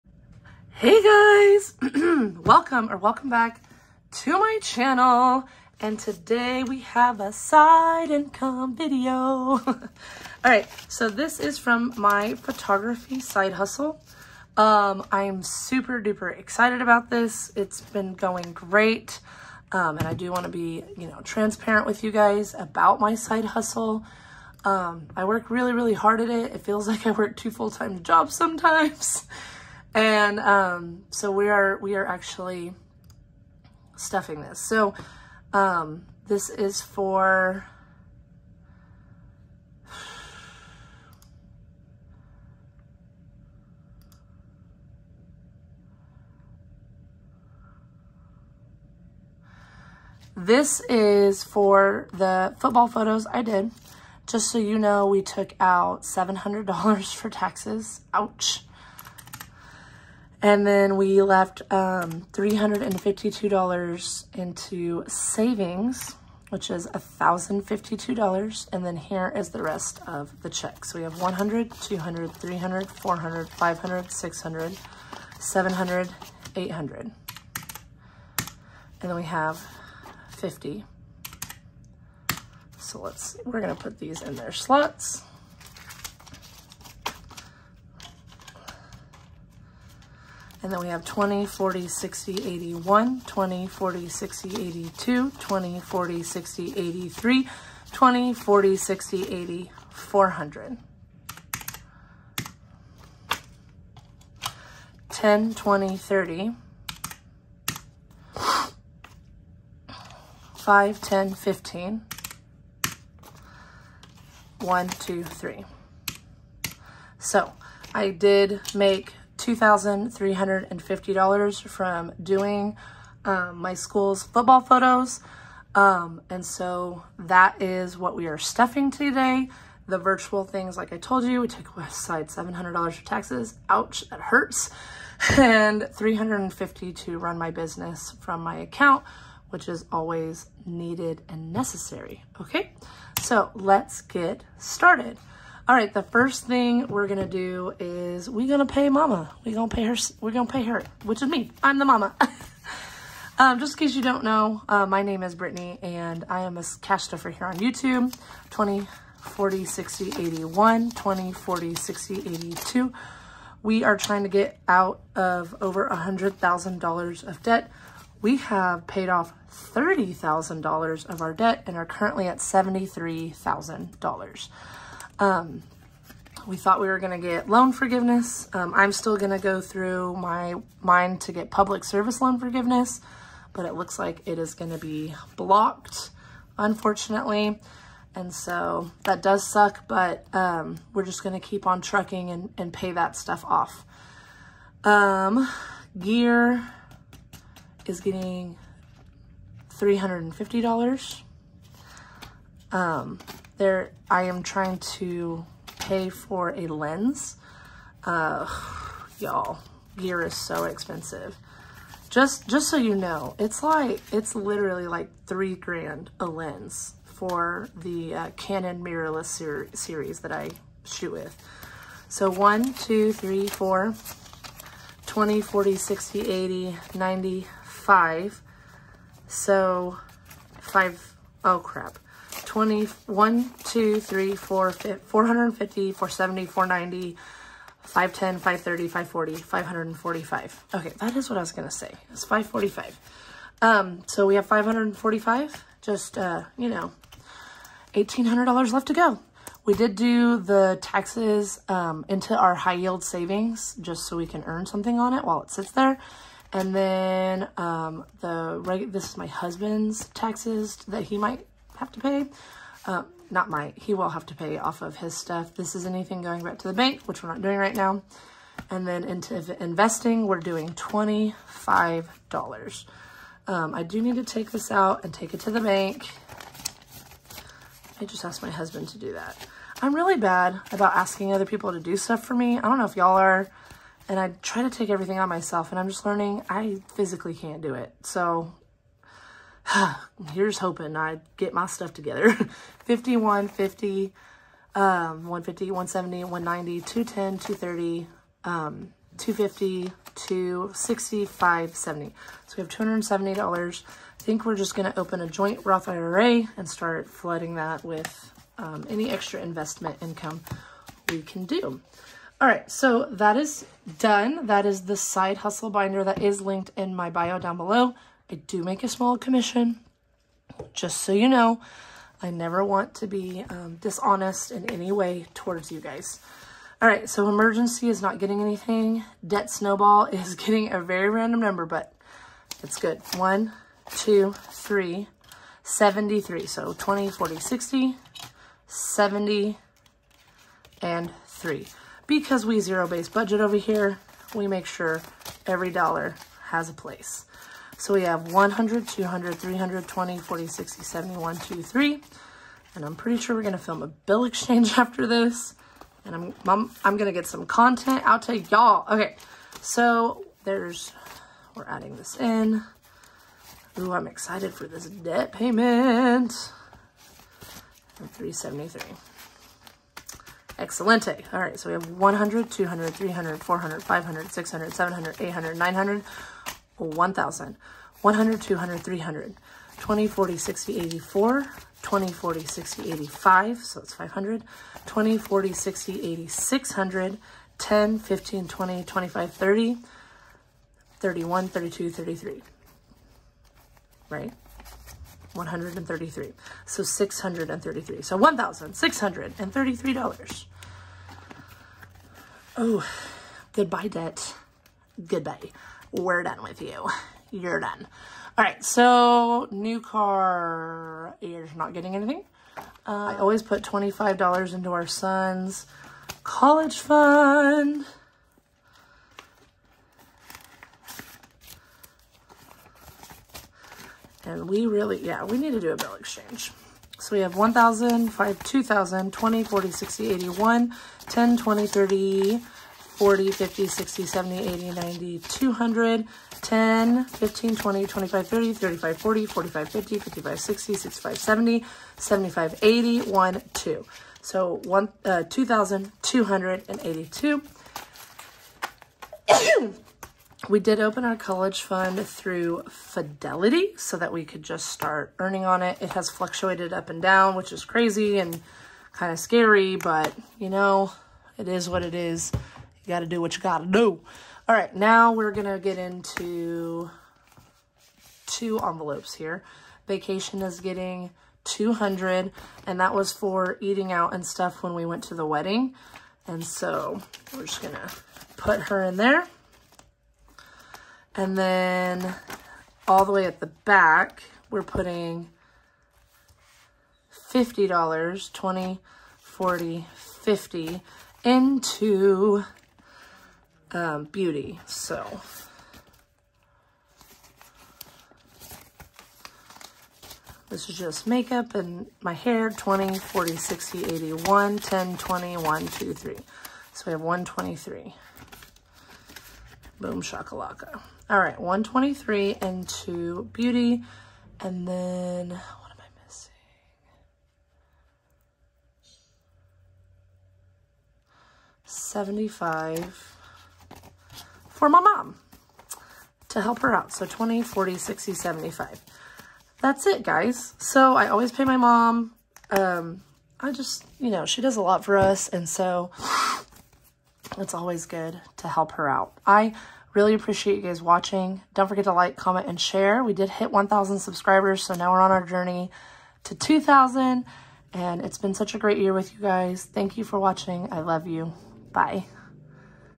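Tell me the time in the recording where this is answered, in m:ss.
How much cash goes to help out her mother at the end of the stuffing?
8:41.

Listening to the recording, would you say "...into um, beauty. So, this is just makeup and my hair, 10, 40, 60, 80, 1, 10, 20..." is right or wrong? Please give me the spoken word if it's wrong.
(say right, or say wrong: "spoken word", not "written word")
wrong: "20", not "10".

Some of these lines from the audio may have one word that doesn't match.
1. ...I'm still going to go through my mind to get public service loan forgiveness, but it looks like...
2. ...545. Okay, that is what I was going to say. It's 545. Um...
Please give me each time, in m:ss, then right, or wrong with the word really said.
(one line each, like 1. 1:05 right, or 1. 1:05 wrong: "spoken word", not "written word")
1. 2:58 right
2. 3:59 right.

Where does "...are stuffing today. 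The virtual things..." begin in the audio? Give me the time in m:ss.
2:08.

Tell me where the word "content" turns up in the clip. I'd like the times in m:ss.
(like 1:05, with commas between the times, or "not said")
5:57.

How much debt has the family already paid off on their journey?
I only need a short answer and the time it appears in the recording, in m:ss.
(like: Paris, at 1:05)
$30,000, at 2:49.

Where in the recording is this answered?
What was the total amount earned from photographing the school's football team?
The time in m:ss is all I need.
1:59.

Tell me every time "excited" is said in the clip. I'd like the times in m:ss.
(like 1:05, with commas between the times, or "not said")
0:16, 6:04.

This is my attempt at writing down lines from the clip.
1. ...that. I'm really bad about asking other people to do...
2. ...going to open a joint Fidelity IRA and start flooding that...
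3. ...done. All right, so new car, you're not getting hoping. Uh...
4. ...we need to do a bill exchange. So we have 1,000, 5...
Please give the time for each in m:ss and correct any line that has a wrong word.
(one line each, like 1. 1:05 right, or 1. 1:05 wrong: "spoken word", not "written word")
1. 4:39 right
2. 5:04 wrong: "Roth", not "Fidelity"
3. 6:47 wrong: "anything", not "hoping"
4. 7:05 right.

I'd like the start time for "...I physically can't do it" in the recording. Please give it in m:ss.
4:46.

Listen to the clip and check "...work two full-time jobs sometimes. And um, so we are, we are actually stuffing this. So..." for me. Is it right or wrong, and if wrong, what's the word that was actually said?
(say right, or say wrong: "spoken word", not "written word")
right.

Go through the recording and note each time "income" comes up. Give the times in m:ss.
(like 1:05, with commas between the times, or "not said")
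0:08, 5:10.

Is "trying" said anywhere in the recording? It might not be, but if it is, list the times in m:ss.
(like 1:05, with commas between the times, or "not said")
2:43, 3:24.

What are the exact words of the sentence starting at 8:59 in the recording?
I really appreciate you guys watching.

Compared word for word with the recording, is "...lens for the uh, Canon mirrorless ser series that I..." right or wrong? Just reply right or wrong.
right.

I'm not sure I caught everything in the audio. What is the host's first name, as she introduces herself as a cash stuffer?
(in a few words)
Brittany.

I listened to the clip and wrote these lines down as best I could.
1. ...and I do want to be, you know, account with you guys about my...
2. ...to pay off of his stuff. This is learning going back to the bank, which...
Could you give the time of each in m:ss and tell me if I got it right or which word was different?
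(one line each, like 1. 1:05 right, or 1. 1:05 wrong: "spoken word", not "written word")
1. 0:19 wrong: "transparent", not "account"
2. 4:24 wrong: "anything", not "learning".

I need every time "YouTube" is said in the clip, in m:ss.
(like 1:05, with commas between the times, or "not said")
2:37.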